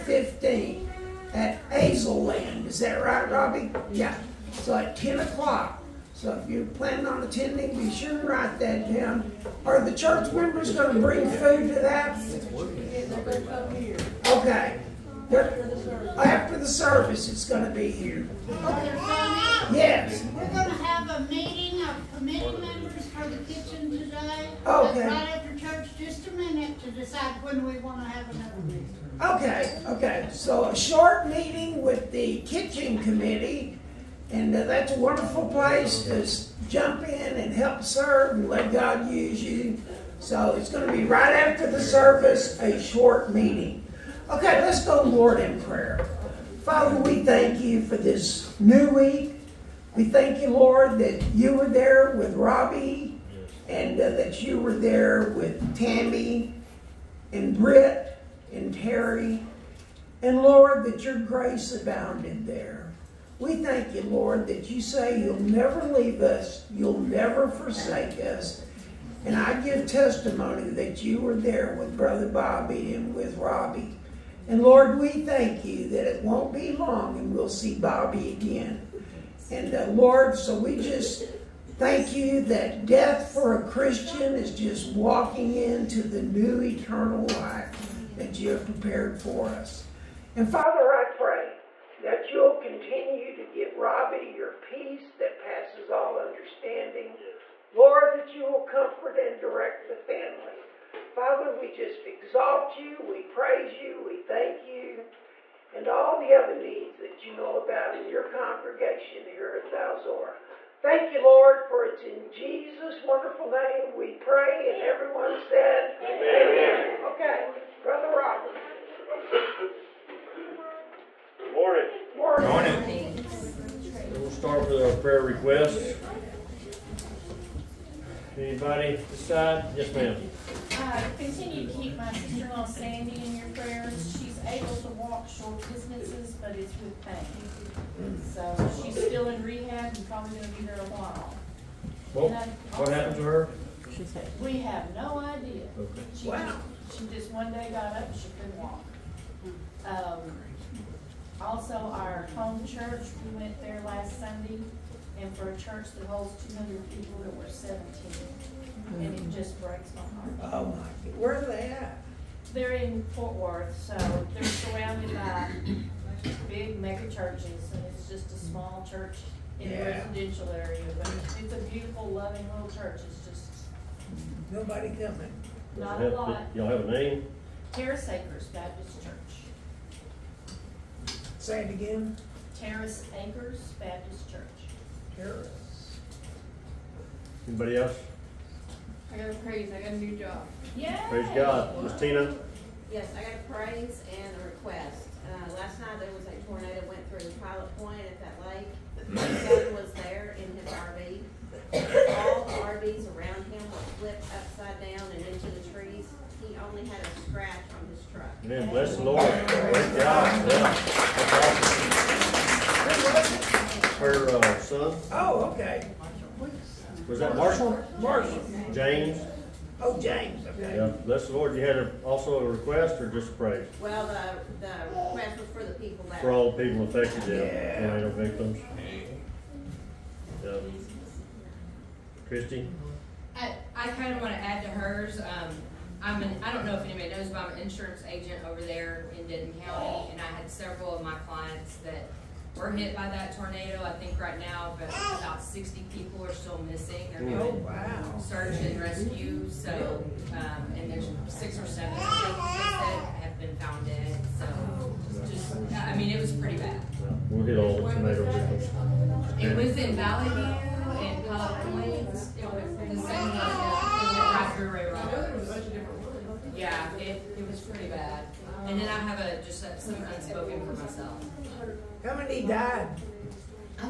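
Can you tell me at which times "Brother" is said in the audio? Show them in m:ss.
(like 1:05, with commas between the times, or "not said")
1:11, 1:57.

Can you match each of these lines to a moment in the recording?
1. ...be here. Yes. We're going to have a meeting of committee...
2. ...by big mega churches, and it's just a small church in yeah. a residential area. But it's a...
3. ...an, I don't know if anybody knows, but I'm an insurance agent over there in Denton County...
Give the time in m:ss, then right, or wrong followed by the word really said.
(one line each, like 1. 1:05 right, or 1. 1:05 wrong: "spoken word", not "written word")
1. 0:17 right
2. 2:45 right
3. 3:56 right.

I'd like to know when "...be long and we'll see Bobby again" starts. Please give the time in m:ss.
1:16.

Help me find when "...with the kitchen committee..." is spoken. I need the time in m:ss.
0:31.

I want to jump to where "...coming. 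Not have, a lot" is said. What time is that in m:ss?
2:54.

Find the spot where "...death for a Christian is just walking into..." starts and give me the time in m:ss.
1:22.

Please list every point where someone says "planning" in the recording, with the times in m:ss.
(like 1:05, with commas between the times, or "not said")
0:06.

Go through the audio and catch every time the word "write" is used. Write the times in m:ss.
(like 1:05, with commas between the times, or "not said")
0:08.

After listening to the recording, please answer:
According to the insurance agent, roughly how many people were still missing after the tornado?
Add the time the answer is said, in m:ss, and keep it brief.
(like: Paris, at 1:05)
60, at 4:05.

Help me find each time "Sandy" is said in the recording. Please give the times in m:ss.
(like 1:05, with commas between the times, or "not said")
2:12.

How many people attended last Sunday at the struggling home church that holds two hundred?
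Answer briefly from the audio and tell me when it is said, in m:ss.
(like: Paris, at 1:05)
17, at 2:37.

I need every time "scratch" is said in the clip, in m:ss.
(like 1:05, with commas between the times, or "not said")
3:27.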